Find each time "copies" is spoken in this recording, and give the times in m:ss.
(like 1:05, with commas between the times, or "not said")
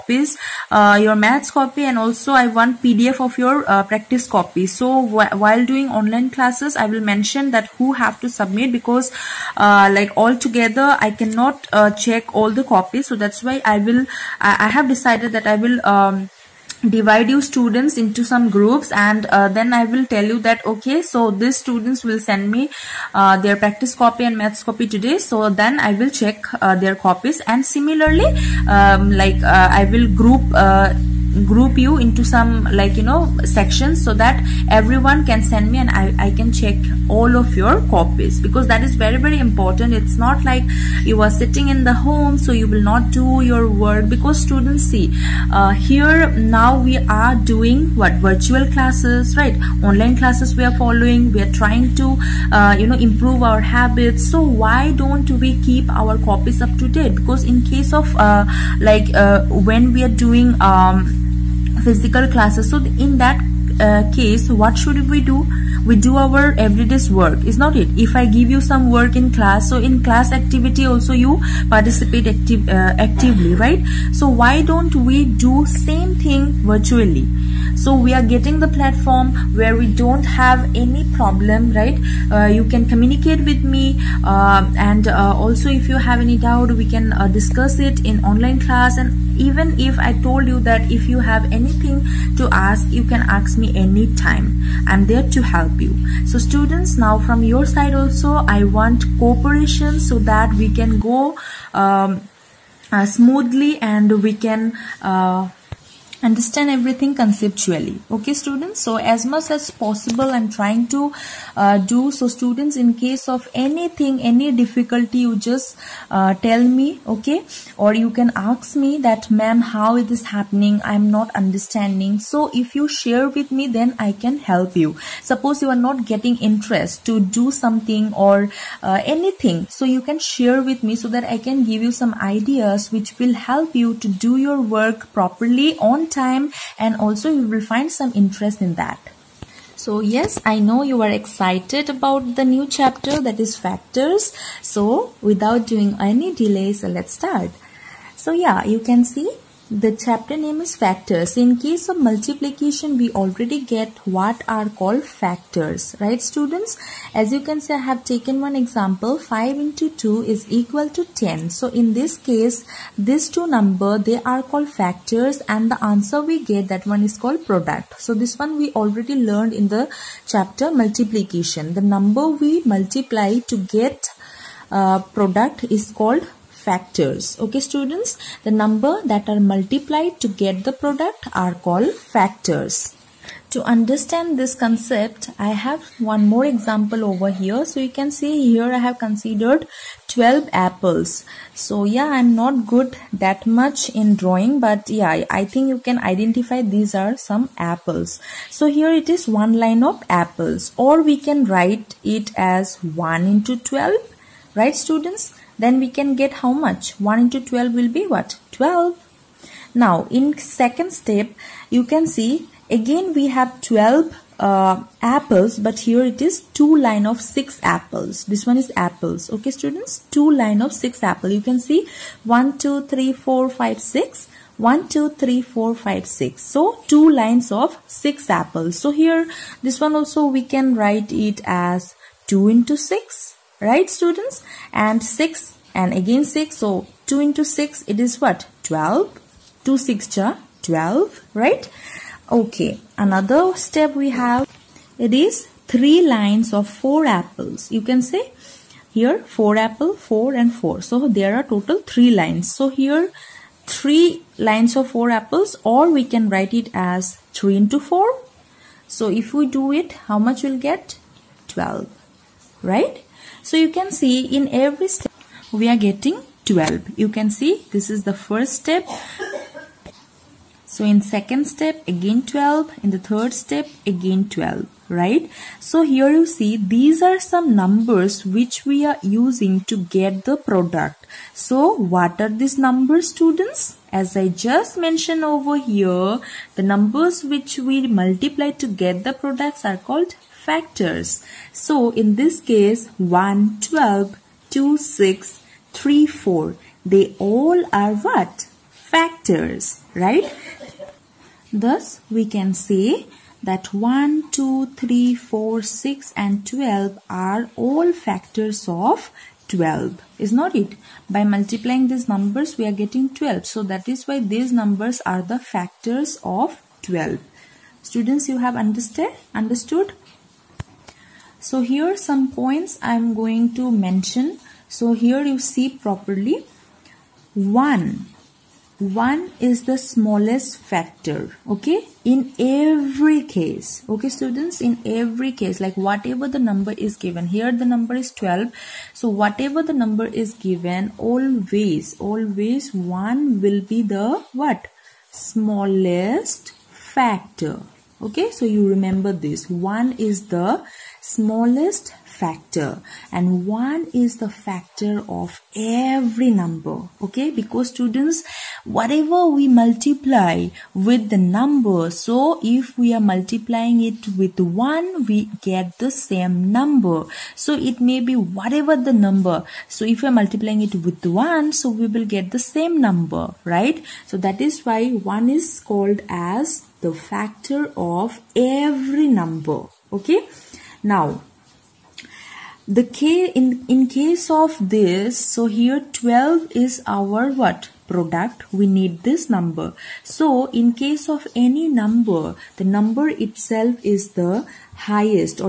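0:12, 0:26, 0:37, 0:56.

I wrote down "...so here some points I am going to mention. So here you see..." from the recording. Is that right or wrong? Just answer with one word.
right.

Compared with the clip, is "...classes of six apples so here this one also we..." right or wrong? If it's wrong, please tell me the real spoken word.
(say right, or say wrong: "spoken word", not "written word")
wrong: "lines", not "classes".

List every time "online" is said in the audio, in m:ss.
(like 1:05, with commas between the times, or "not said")
0:05, 0:49, 1:28.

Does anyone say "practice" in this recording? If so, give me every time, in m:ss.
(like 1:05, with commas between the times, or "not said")
0:03, 0:23.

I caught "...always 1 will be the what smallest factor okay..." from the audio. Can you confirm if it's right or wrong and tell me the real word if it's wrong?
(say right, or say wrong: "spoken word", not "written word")
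right.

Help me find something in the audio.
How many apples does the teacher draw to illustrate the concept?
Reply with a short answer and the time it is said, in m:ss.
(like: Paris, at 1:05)
12, at 3:10.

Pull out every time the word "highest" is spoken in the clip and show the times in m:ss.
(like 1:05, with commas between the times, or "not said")
6:34.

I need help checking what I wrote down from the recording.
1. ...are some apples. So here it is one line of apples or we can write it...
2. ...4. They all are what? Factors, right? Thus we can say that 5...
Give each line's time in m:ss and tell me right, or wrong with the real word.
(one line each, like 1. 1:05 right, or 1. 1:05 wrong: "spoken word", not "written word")
1. 3:16 right
2. 4:56 wrong: "1", not "5".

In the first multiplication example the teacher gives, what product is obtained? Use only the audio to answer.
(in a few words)
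10.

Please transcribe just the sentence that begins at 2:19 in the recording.
So yes, I know you are excited about the new chapter that is factors.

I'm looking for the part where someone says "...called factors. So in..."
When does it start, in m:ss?
4:49.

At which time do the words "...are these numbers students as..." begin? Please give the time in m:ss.
4:42.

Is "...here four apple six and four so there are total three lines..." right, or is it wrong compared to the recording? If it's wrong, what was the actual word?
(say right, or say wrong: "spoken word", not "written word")
wrong: "four", not "six".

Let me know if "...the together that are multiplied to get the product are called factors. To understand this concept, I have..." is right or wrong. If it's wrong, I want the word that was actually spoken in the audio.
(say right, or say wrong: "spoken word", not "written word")
wrong: "number", not "together".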